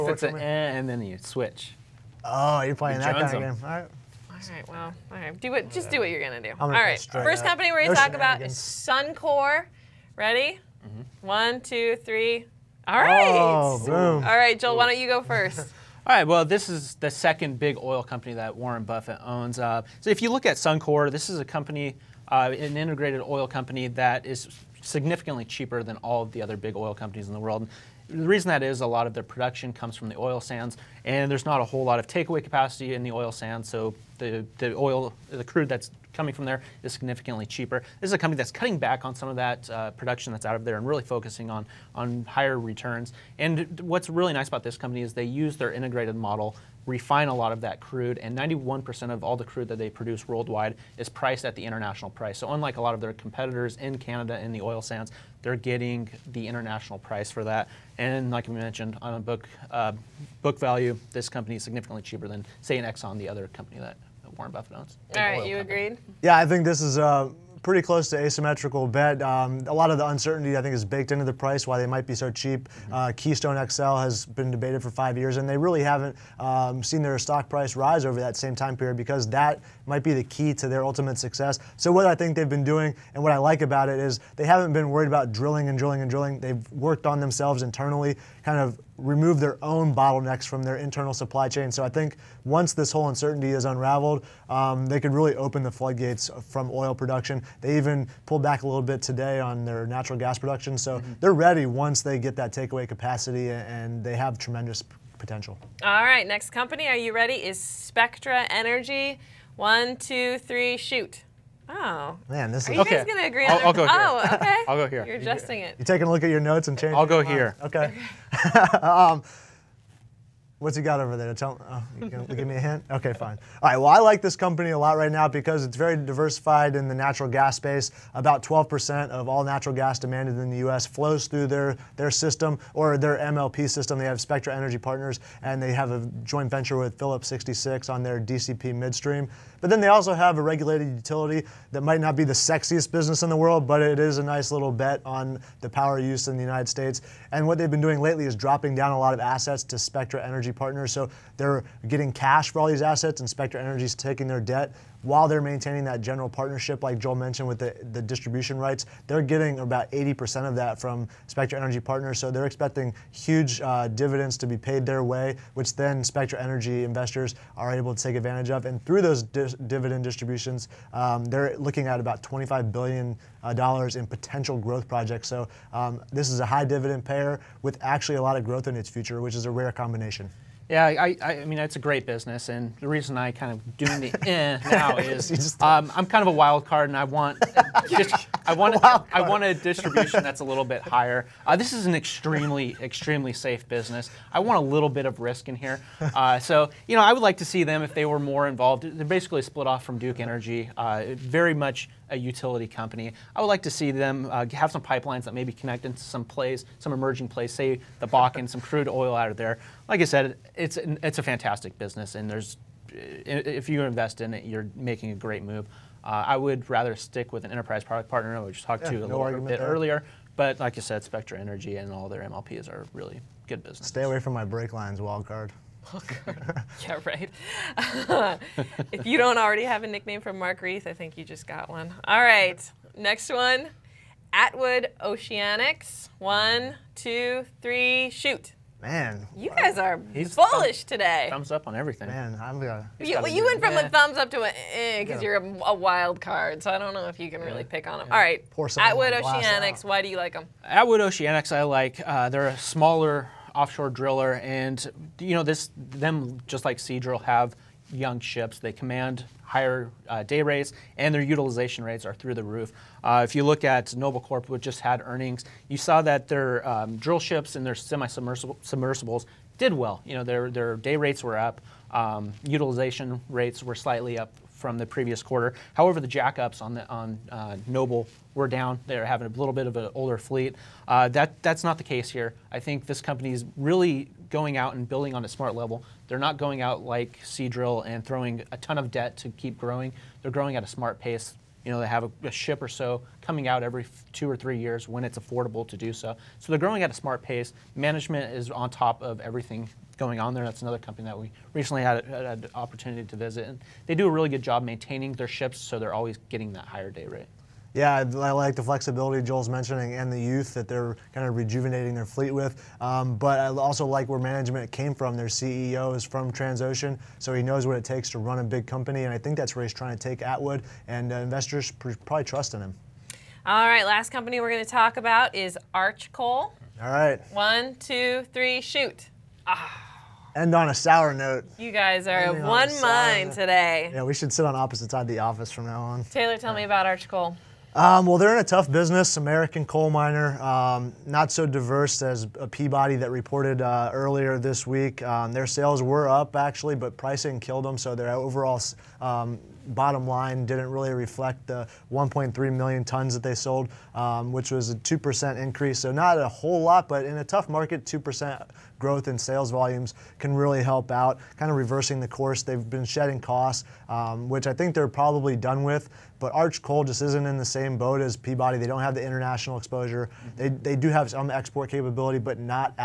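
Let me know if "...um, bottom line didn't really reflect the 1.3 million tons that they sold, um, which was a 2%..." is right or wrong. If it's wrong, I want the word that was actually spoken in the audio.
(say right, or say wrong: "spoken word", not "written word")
right.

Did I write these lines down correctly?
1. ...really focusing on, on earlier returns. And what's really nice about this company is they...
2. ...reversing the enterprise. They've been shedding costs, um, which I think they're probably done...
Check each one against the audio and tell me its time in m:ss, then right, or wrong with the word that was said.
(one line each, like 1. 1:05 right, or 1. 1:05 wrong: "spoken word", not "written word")
1. 0:40 wrong: "higher", not "earlier"
2. 6:01 wrong: "course", not "enterprise".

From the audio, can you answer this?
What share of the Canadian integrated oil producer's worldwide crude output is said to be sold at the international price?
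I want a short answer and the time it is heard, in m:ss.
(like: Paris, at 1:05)
91%, at 0:48.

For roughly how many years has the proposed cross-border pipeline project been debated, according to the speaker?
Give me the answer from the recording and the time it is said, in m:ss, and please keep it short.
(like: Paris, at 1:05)
5, at 1:14.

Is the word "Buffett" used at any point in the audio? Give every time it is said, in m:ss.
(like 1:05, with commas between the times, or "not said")
0:18, 1:04.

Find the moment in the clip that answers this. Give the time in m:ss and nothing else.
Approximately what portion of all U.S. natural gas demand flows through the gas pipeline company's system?
2:08.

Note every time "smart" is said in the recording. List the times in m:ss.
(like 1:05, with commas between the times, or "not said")
4:45, 4:50, 4:56.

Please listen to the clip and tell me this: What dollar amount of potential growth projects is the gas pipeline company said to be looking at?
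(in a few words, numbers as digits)
$25 billion.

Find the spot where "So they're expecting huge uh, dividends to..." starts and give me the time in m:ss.
2:42.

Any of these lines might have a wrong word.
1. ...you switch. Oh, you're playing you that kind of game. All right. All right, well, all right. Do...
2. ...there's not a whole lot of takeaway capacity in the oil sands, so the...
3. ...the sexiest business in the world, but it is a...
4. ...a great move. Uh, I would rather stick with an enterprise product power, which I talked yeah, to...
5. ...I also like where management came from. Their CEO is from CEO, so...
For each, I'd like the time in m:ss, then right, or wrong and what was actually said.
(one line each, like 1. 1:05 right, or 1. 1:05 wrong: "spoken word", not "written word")
1. 0:00 right
2. 0:31 right
3. 2:22 right
4. 3:35 wrong: "partner", not "power"
5. 5:13 wrong: "Transocean", not "CEO".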